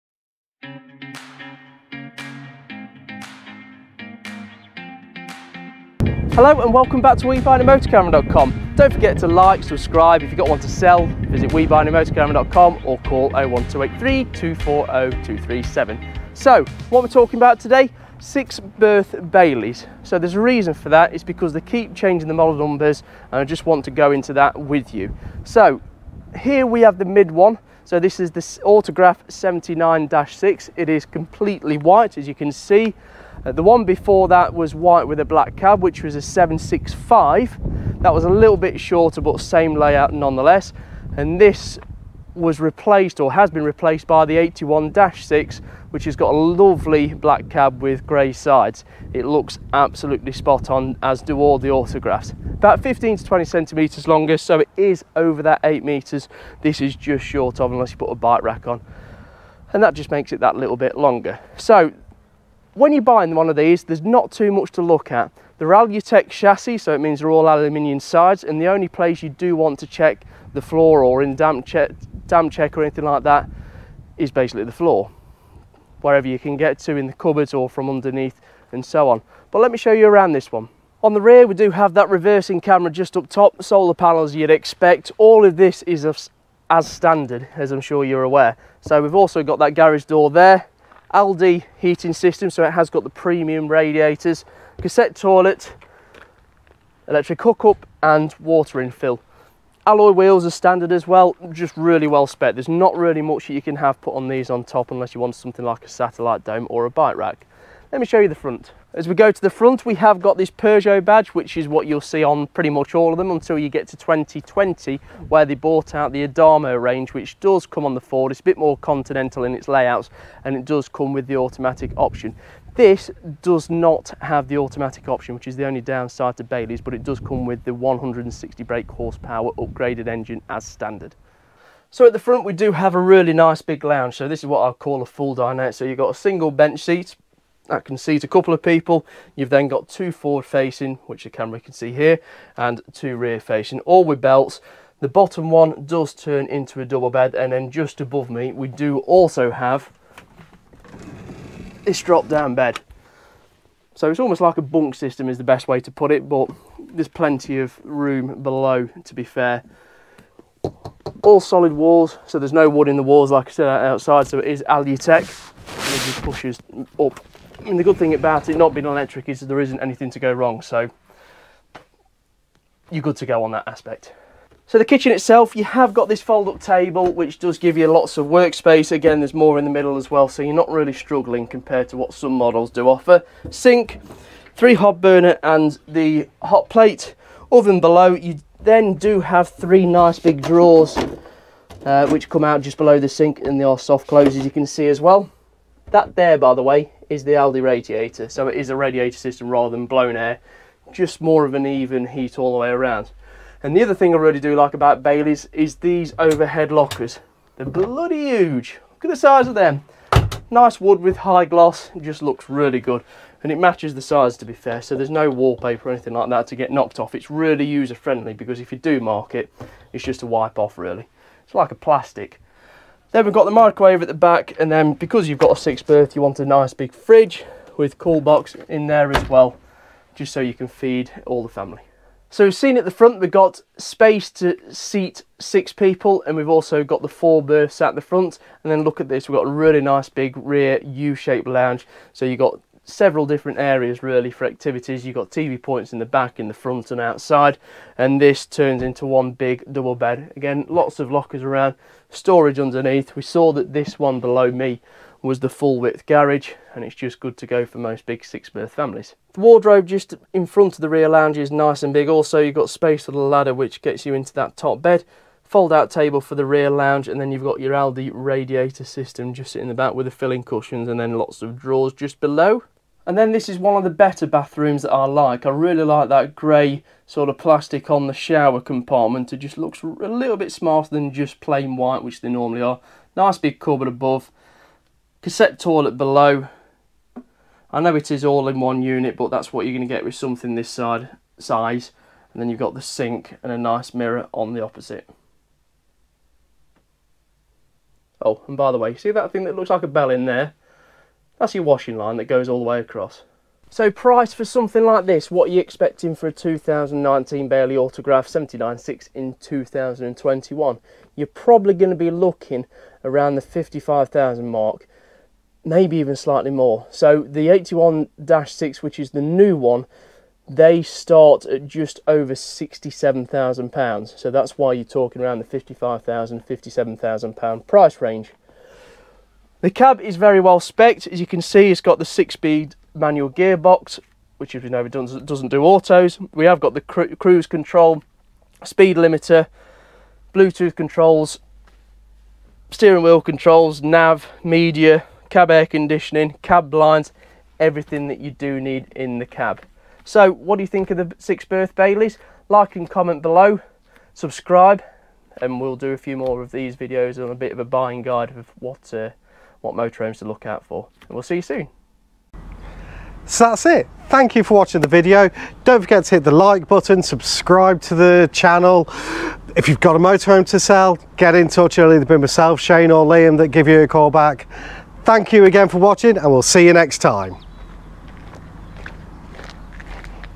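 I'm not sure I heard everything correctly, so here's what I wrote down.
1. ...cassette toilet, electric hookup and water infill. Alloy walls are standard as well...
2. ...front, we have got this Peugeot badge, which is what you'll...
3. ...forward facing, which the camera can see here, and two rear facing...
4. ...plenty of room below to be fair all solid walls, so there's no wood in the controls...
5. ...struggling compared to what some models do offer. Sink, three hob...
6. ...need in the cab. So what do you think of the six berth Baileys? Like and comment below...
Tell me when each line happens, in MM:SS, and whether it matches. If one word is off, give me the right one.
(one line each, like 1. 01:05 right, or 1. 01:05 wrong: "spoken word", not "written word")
1. 01:34 wrong: "wheels", not "walls"
2. 01:49 right
3. 02:20 right
4. 02:37 wrong: "walls", not "controls"
5. 03:00 right
6. 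05:48 right.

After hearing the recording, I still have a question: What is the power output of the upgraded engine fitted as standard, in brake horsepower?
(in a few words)
160.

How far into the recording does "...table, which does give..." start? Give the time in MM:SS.
02:56.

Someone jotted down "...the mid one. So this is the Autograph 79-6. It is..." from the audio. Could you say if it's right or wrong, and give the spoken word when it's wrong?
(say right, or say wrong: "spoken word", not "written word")
right.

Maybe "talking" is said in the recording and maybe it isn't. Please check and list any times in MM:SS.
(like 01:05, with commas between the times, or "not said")
00:17, 05:24.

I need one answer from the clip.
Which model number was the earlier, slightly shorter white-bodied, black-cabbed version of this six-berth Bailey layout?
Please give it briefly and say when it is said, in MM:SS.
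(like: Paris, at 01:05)
765, at 00:36.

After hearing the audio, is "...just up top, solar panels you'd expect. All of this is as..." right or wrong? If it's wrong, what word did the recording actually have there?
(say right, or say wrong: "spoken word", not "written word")
right.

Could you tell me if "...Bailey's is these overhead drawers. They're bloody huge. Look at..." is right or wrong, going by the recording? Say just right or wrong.
wrong.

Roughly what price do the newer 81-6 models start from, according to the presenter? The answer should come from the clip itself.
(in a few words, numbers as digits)
£67,000.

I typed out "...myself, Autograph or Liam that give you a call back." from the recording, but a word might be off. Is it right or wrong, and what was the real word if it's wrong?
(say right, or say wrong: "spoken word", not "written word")
wrong: "Shane", not "Autograph".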